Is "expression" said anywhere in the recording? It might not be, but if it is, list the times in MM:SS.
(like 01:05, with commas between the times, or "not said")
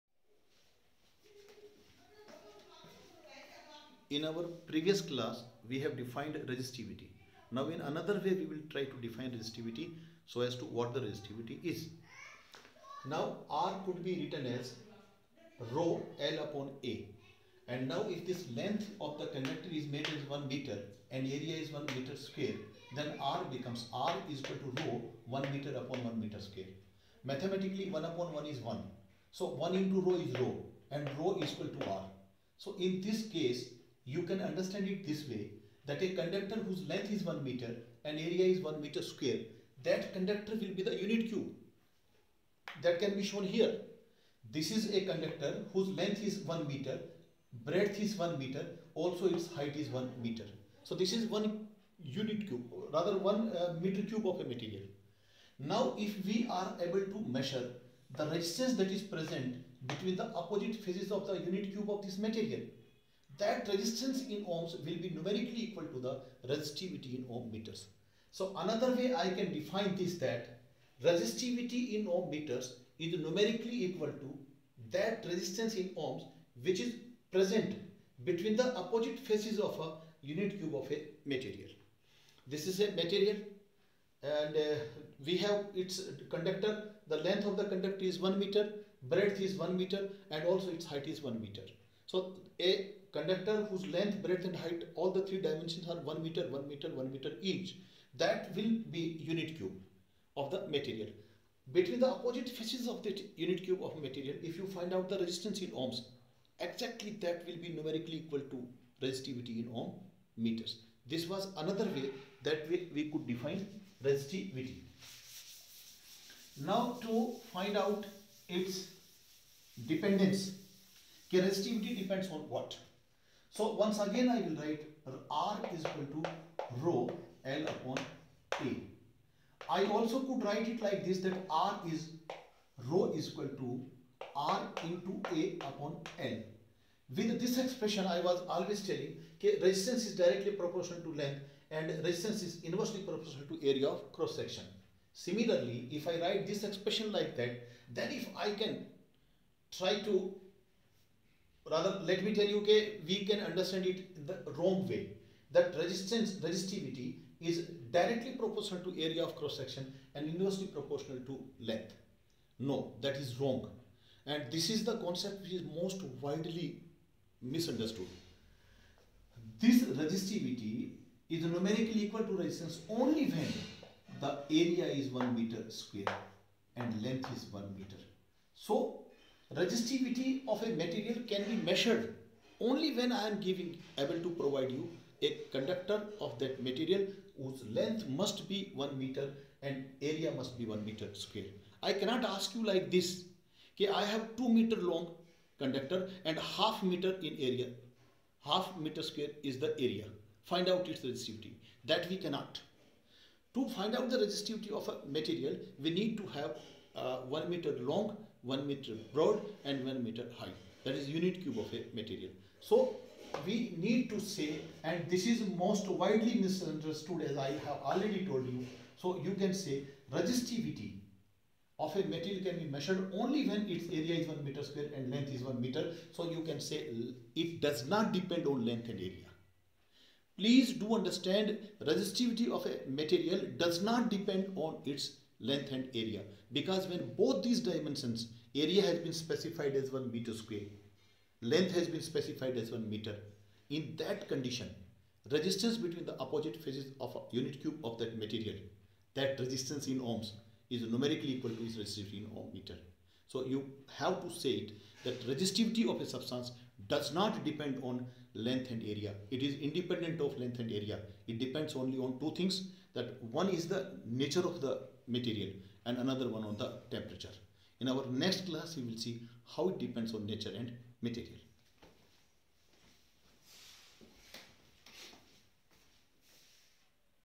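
02:17, 02:26.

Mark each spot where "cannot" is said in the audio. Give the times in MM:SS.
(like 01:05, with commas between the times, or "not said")
03:11, 03:22.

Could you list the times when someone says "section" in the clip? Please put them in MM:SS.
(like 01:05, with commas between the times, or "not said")
02:24, 02:39.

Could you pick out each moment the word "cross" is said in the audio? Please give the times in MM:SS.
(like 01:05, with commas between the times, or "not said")
02:24, 02:39.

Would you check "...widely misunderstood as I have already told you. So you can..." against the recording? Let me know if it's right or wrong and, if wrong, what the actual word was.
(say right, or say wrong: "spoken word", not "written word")
right.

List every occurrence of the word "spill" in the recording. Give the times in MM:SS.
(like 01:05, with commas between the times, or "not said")
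not said.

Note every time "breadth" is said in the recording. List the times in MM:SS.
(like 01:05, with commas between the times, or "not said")
00:47, 01:29, 01:34.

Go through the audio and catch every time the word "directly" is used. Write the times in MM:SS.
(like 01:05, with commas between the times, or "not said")
02:20, 02:37.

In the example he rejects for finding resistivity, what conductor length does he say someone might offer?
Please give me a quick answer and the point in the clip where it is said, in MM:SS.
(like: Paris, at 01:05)
2 meters, at 03:14.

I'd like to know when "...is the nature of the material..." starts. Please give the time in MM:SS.
04:23.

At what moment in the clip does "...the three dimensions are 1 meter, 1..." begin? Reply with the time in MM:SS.
01:35.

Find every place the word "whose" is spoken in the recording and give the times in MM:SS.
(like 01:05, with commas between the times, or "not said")
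00:36, 00:45, 01:33, 03:07.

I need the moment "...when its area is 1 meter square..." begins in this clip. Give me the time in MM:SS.
03:43.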